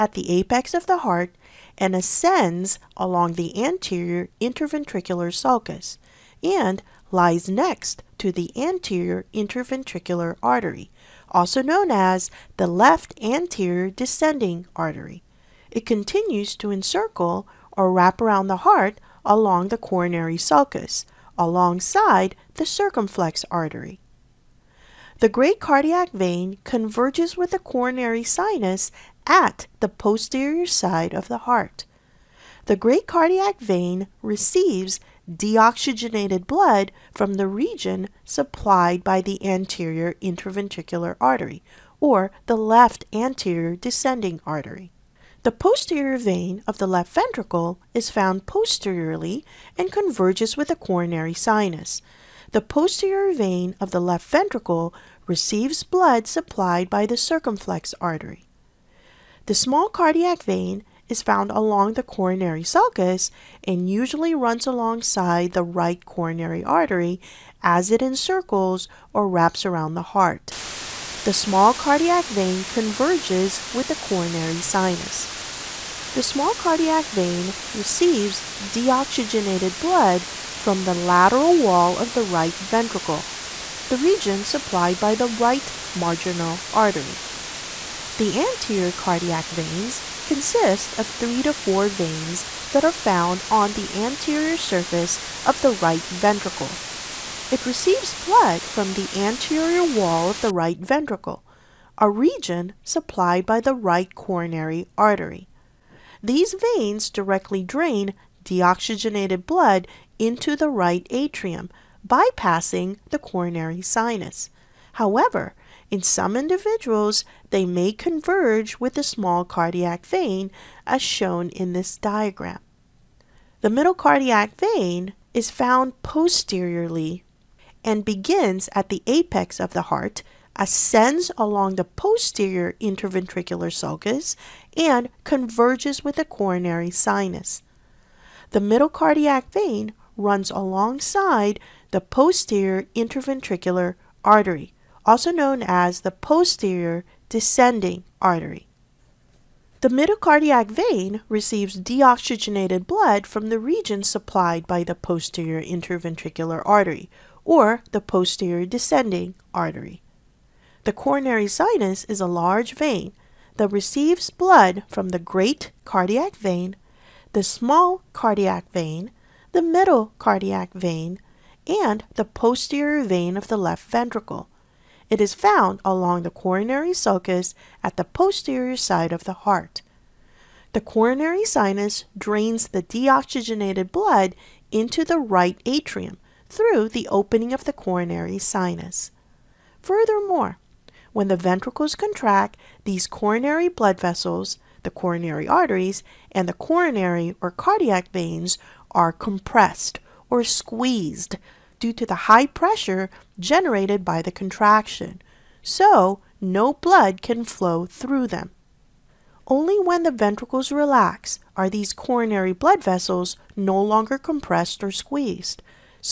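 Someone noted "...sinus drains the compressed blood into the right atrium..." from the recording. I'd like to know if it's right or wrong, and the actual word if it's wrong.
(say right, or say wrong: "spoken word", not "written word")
wrong: "deoxygenated", not "compressed".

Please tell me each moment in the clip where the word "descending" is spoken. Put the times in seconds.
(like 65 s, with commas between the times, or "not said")
13 s, 43 s, 147 s, 158 s.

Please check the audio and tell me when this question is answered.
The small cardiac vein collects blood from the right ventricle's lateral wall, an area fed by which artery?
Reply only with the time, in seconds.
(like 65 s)
85 s.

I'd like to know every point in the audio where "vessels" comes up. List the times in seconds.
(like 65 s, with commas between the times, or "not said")
194 s, 212 s.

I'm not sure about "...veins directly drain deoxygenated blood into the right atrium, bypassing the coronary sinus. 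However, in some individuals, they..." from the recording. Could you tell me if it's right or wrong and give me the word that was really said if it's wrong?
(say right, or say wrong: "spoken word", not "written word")
right.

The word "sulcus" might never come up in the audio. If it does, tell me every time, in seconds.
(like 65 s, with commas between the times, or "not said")
5 s, 20 s, 62 s, 133 s, 176 s.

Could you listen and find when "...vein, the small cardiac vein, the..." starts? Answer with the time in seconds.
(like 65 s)
166 s.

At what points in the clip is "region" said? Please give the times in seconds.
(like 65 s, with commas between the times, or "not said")
37 s, 83 s, 102 s, 153 s.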